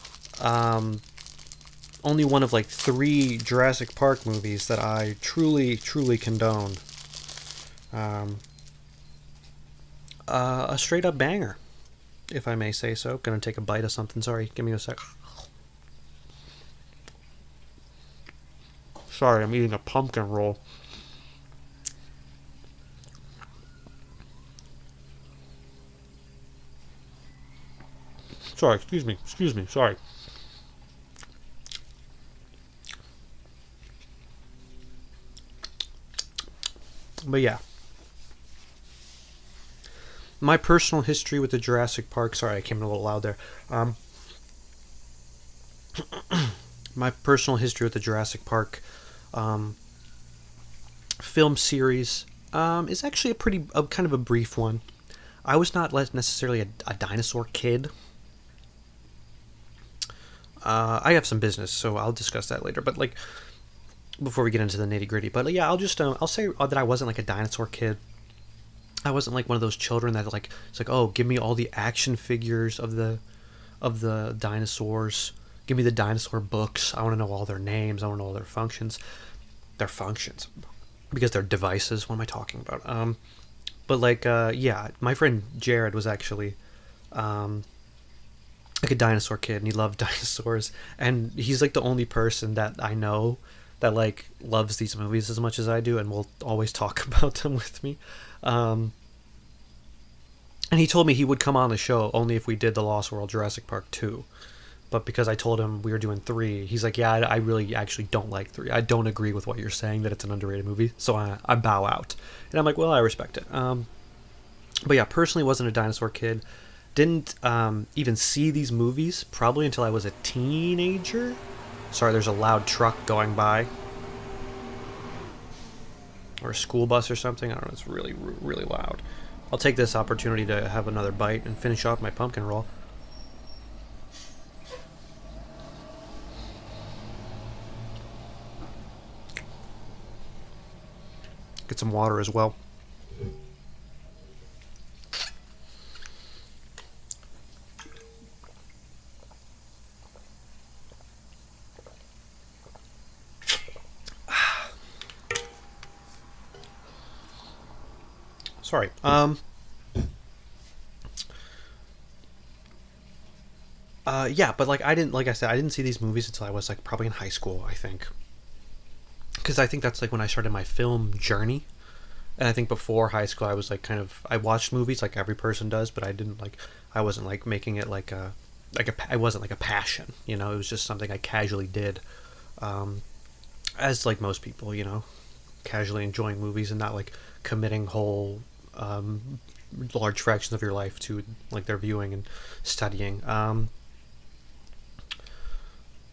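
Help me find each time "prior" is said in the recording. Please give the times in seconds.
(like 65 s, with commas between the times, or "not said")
not said.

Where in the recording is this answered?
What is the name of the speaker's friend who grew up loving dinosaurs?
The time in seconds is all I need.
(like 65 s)
85 s.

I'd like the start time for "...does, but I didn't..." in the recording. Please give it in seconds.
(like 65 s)
175 s.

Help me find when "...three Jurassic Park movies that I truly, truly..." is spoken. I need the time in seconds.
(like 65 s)
2 s.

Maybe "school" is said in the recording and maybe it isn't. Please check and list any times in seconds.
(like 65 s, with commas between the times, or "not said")
126 s, 167 s, 173 s.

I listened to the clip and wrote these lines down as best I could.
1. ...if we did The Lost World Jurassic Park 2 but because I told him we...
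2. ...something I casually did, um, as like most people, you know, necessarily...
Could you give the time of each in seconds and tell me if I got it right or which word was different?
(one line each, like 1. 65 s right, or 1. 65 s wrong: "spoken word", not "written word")
1. 102 s right
2. 180 s wrong: "casually", not "necessarily".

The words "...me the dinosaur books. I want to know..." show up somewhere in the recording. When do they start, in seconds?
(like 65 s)
75 s.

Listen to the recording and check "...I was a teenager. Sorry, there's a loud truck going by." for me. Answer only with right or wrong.
right.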